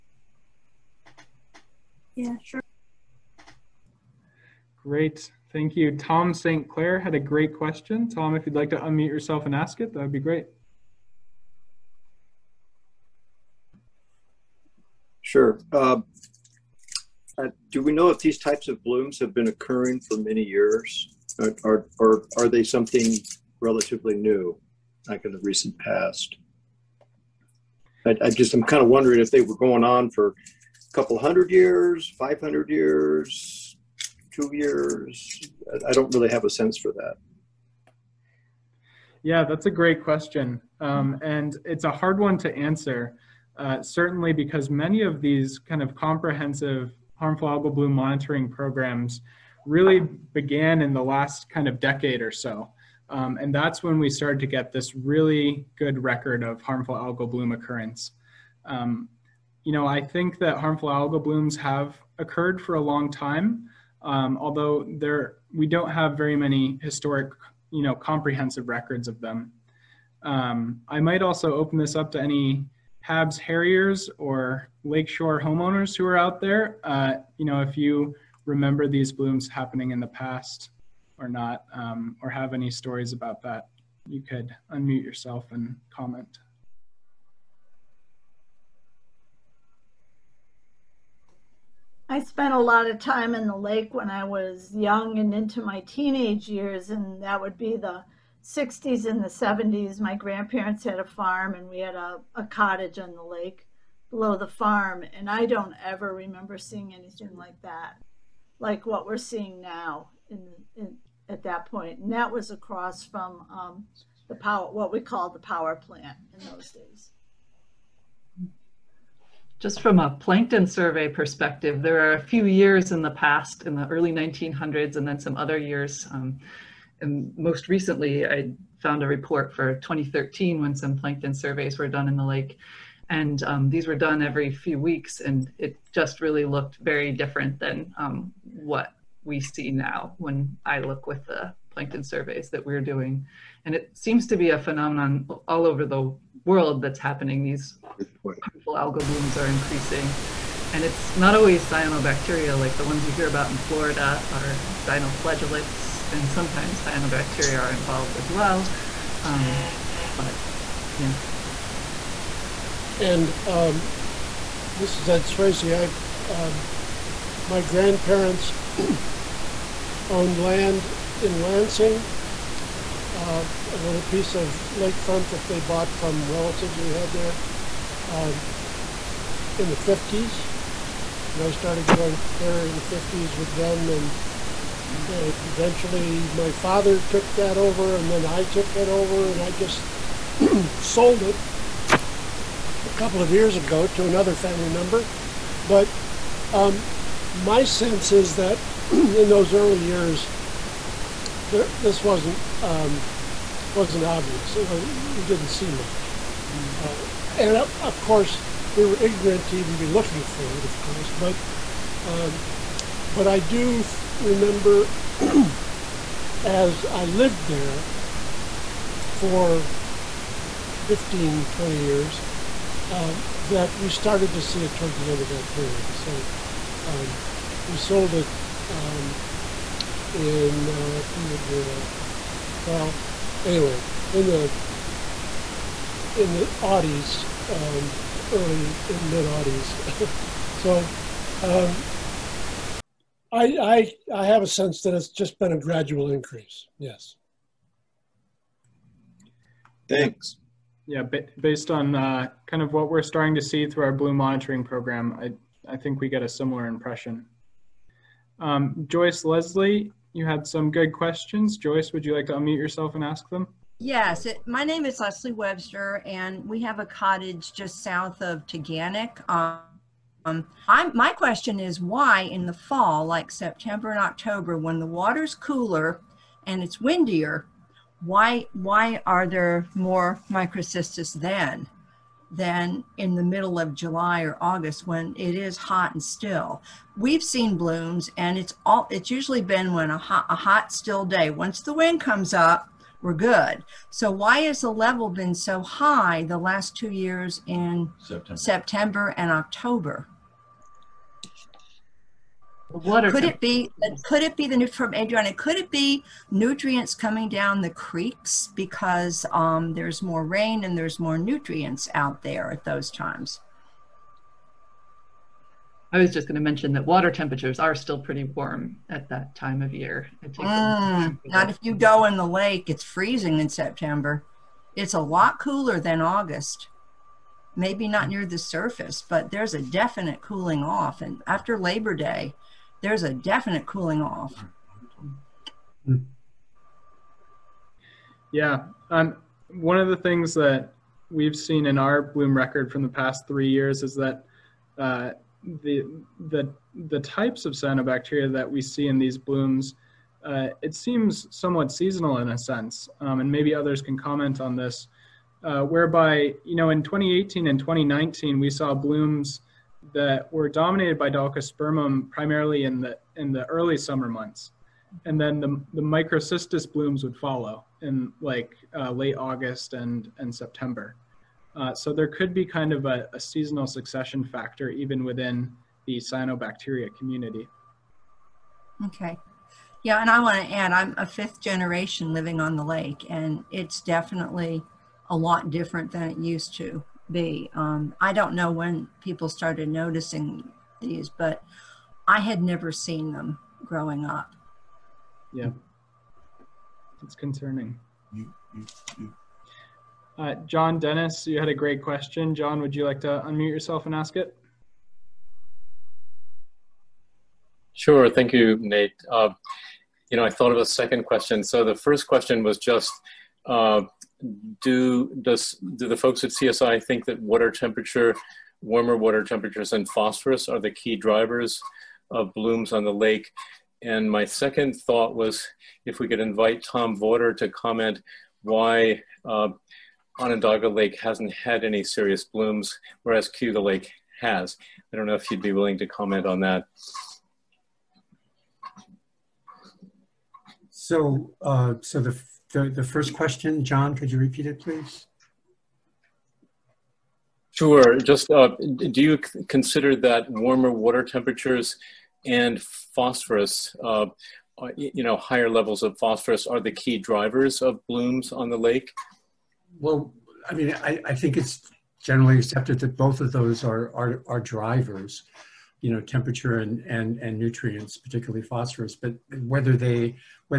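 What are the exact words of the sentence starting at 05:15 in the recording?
I was just going to mention that water temperatures are still pretty warm at that time of year.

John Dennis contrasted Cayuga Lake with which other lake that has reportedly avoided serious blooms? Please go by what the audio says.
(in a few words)
Onondaga Lake.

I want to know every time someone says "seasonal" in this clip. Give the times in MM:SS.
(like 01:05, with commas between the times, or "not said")
05:51, 06:13.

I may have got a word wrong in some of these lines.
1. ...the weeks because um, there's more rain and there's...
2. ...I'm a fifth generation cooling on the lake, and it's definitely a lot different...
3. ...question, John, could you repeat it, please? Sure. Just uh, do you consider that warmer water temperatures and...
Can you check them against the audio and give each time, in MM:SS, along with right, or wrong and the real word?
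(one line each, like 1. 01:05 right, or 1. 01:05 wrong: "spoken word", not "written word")
1. 05:07 wrong: "creeks", not "weeks"
2. 06:20 wrong: "living", not "cooling"
3. 07:23 right.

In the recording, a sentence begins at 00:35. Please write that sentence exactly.
I- I don't really have a sense for that.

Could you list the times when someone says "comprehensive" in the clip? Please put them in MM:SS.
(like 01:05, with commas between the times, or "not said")
00:45, 01:07.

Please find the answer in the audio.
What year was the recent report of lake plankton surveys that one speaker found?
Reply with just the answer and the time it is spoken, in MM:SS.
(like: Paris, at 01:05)
2013, at 02:09.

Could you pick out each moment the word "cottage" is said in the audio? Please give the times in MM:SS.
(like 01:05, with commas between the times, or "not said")
01:42, 04:26.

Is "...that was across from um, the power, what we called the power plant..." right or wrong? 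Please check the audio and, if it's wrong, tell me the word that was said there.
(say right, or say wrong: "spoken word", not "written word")
right.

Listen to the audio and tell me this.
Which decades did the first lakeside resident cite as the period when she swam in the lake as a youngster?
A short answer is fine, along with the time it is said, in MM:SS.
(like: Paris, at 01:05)
the 60s and 70s, at 01:37.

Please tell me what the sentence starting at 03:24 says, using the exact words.
It was you didn't see much, mm-hmm.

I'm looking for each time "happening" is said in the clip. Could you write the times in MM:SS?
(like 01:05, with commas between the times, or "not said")
01:19, 02:27.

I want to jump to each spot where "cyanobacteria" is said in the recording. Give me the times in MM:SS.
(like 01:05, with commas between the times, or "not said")
02:31, 02:36, 05:47, 06:15.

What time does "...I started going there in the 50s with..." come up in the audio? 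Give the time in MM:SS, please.
03:01.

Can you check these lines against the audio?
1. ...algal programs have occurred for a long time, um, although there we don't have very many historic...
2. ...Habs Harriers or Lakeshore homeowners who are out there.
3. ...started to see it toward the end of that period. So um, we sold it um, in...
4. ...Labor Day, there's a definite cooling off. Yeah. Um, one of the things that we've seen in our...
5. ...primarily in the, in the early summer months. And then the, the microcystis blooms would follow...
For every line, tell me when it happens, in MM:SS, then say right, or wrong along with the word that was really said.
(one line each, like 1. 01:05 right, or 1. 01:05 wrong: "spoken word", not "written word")
1. 01:00 wrong: "blooms", not "programs"
2. 01:13 right
3. 03:43 right
4. 05:31 right
5. 06:02 right.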